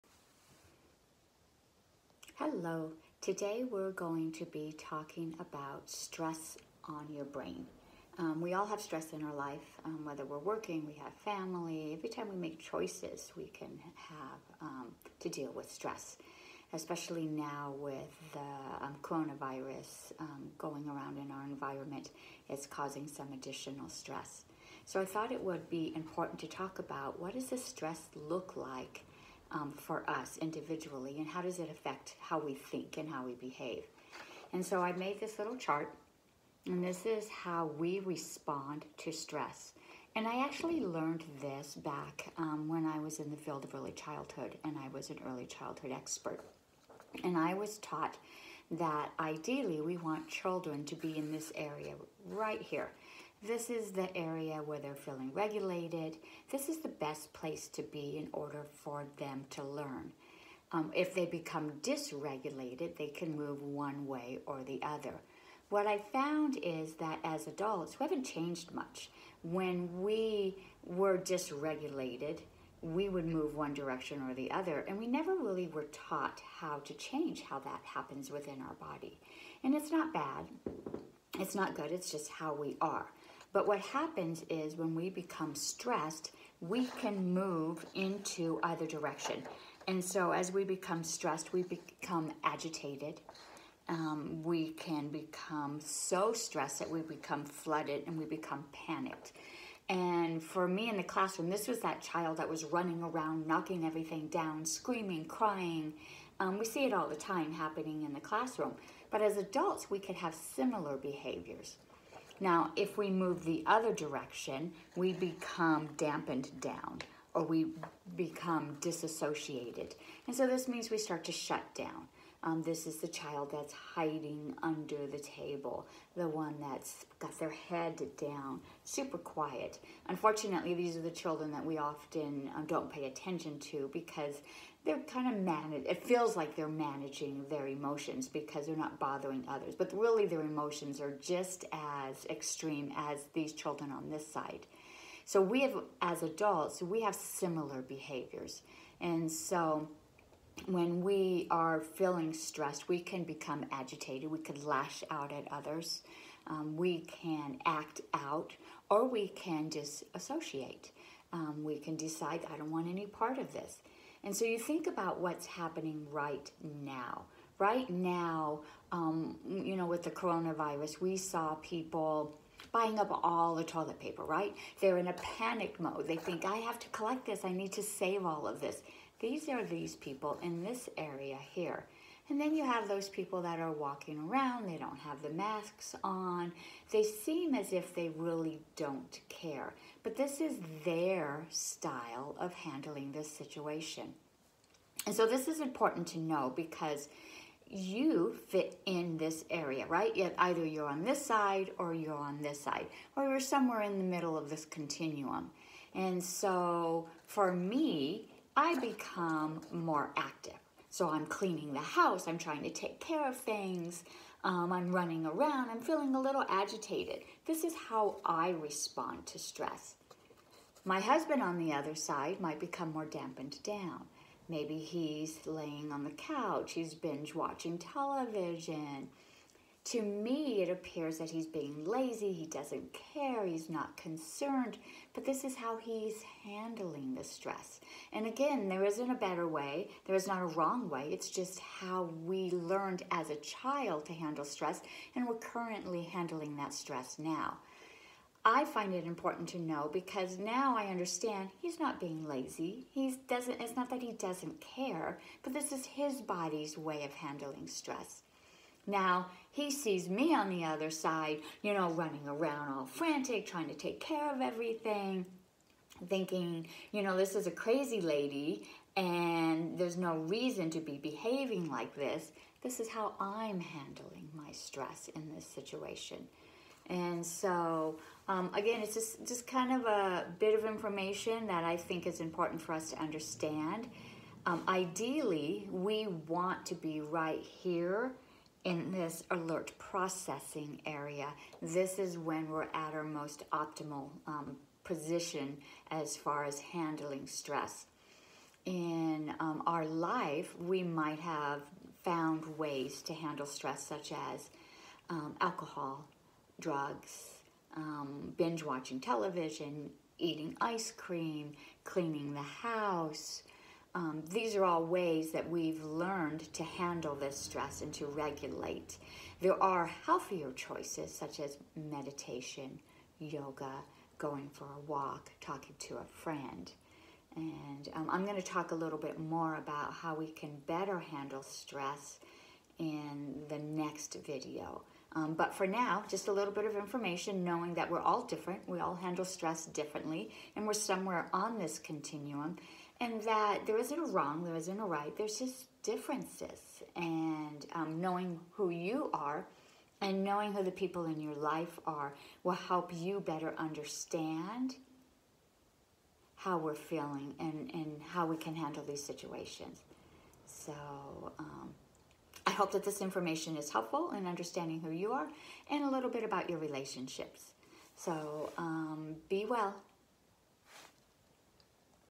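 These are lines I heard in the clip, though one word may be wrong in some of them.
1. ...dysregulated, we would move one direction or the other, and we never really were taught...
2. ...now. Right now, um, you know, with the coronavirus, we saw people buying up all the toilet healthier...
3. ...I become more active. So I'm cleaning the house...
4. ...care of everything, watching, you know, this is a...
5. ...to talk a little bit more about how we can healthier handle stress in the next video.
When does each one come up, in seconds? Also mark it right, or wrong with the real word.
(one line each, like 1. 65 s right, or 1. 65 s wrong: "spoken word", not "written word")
1. 71 s right
2. 166 s wrong: "paper", not "healthier"
3. 208 s right
4. 264 s wrong: "thinking", not "watching"
5. 328 s wrong: "better", not "healthier".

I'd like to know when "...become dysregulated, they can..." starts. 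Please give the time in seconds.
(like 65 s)
61 s.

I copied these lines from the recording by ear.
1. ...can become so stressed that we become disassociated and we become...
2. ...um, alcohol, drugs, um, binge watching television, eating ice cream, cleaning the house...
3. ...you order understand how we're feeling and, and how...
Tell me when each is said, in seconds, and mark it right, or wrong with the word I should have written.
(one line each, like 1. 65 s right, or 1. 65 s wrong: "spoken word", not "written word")
1. 94 s wrong: "flooded", not "disassociated"
2. 305 s right
3. 352 s wrong: "better", not "order".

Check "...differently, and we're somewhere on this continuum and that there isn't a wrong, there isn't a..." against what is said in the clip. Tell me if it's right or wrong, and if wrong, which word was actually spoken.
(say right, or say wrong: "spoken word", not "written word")
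right.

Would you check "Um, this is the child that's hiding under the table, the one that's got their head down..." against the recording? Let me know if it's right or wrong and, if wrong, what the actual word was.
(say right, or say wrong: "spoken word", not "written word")
right.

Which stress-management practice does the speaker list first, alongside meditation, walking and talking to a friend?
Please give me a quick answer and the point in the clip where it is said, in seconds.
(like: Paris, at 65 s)
yoga, at 323 s.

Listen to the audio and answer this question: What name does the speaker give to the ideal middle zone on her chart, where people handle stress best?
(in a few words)
alert processing.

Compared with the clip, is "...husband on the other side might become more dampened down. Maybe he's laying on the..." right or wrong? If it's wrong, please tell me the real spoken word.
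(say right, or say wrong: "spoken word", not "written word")
right.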